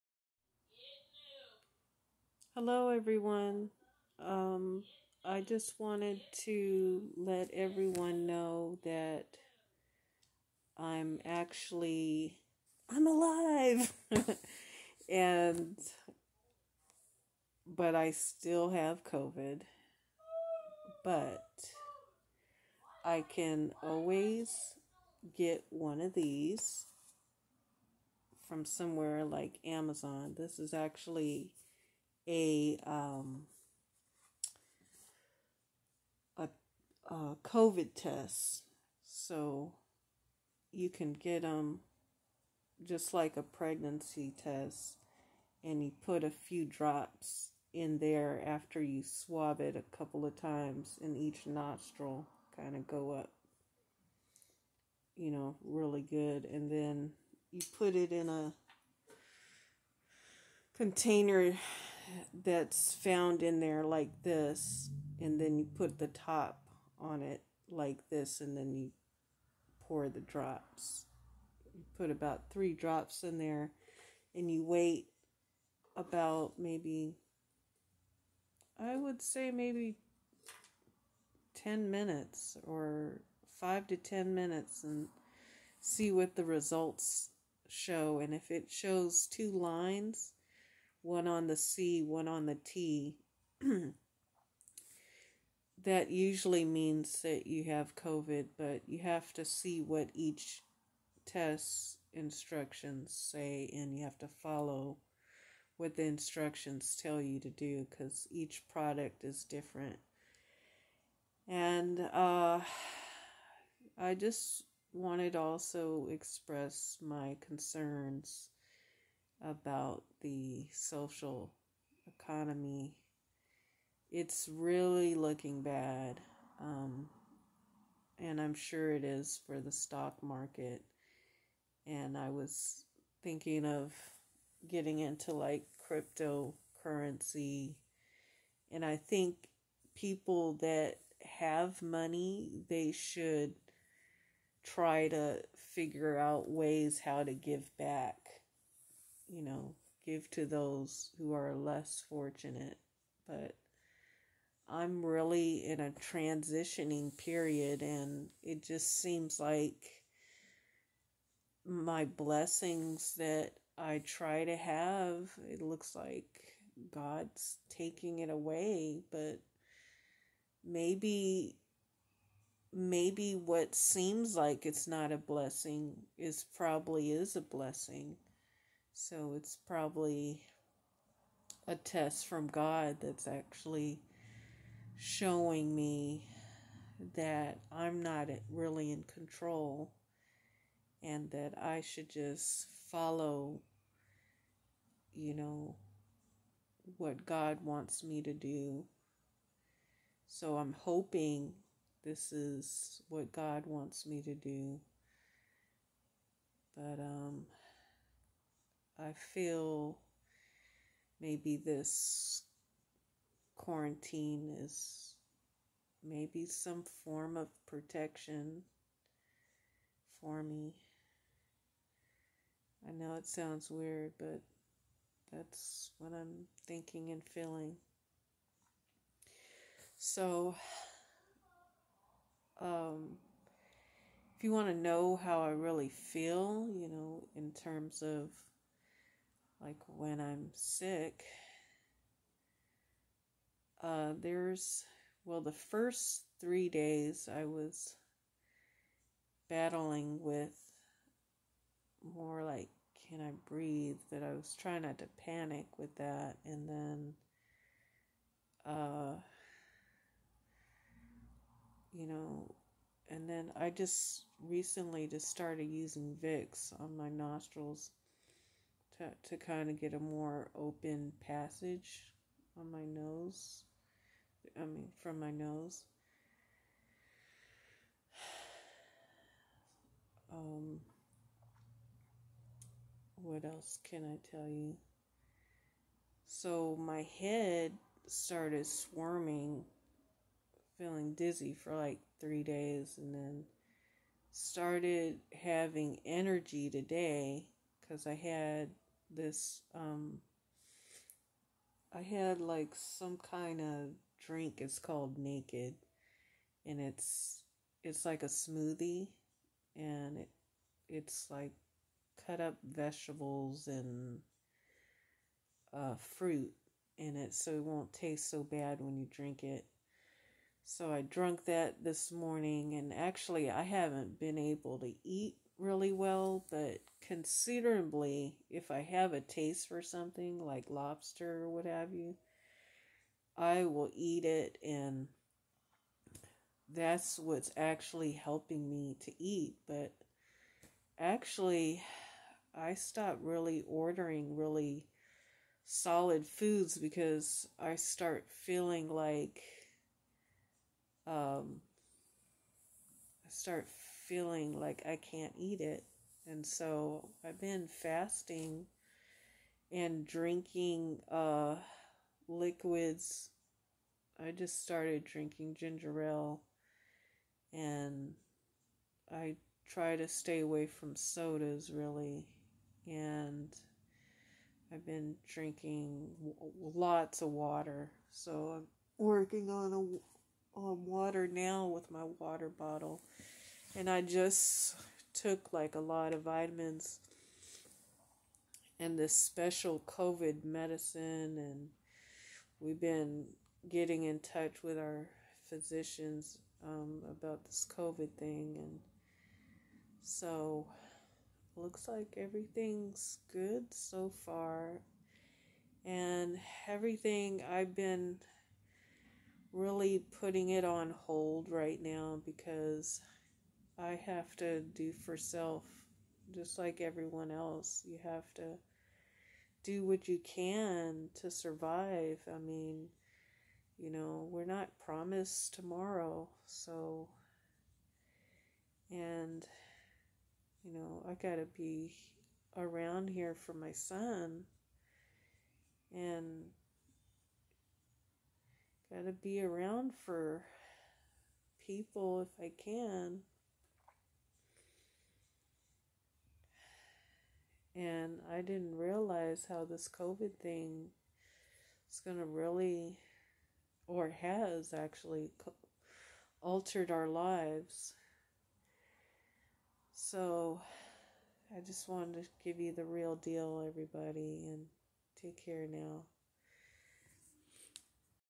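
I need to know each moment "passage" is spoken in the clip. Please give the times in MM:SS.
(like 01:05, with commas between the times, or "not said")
04:31.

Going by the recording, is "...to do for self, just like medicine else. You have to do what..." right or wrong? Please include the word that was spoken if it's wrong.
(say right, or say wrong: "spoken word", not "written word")
wrong: "everyone", not "medicine".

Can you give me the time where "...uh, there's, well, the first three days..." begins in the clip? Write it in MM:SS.
04:03.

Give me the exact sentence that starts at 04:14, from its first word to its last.
But I was trying not to panic with that.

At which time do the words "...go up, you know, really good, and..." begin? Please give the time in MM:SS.
00:52.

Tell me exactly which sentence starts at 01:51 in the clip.
And uh, I just wanted to also express my concerns about the social economy.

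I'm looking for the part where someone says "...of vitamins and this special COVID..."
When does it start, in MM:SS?
06:26.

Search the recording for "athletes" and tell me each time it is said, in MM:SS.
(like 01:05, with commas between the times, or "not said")
not said.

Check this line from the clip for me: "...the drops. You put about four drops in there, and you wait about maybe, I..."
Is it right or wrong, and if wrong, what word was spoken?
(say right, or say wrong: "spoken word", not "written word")
wrong: "three", not "four".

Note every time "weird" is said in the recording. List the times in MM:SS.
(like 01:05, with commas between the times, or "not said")
03:43.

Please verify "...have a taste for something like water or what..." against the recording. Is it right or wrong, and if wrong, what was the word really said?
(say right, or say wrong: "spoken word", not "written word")
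wrong: "lobster", not "water".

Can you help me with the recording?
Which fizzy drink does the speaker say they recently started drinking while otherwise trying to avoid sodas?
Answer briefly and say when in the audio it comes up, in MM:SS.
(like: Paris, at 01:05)
Ginger ale, at 06:05.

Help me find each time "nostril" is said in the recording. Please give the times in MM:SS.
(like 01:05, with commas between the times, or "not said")
00:51, 04:27.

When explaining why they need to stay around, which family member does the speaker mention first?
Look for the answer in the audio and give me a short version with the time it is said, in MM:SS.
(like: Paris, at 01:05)
Son, at 07:13.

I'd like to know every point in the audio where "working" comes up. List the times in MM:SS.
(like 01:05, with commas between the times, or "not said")
06:18.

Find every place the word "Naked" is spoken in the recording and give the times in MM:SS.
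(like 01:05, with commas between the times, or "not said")
05:05.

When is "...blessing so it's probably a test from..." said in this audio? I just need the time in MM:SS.
02:57.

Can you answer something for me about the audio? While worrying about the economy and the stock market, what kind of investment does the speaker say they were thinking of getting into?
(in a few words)
Cryptocurrency.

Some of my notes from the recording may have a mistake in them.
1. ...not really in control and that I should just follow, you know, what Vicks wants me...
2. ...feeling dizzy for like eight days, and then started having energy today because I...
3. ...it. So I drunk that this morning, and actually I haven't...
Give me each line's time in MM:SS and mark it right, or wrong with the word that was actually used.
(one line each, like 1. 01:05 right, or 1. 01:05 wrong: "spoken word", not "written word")
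1. 03:08 wrong: "God", not "Vicks"
2. 04:50 wrong: "three", not "eight"
3. 05:19 right.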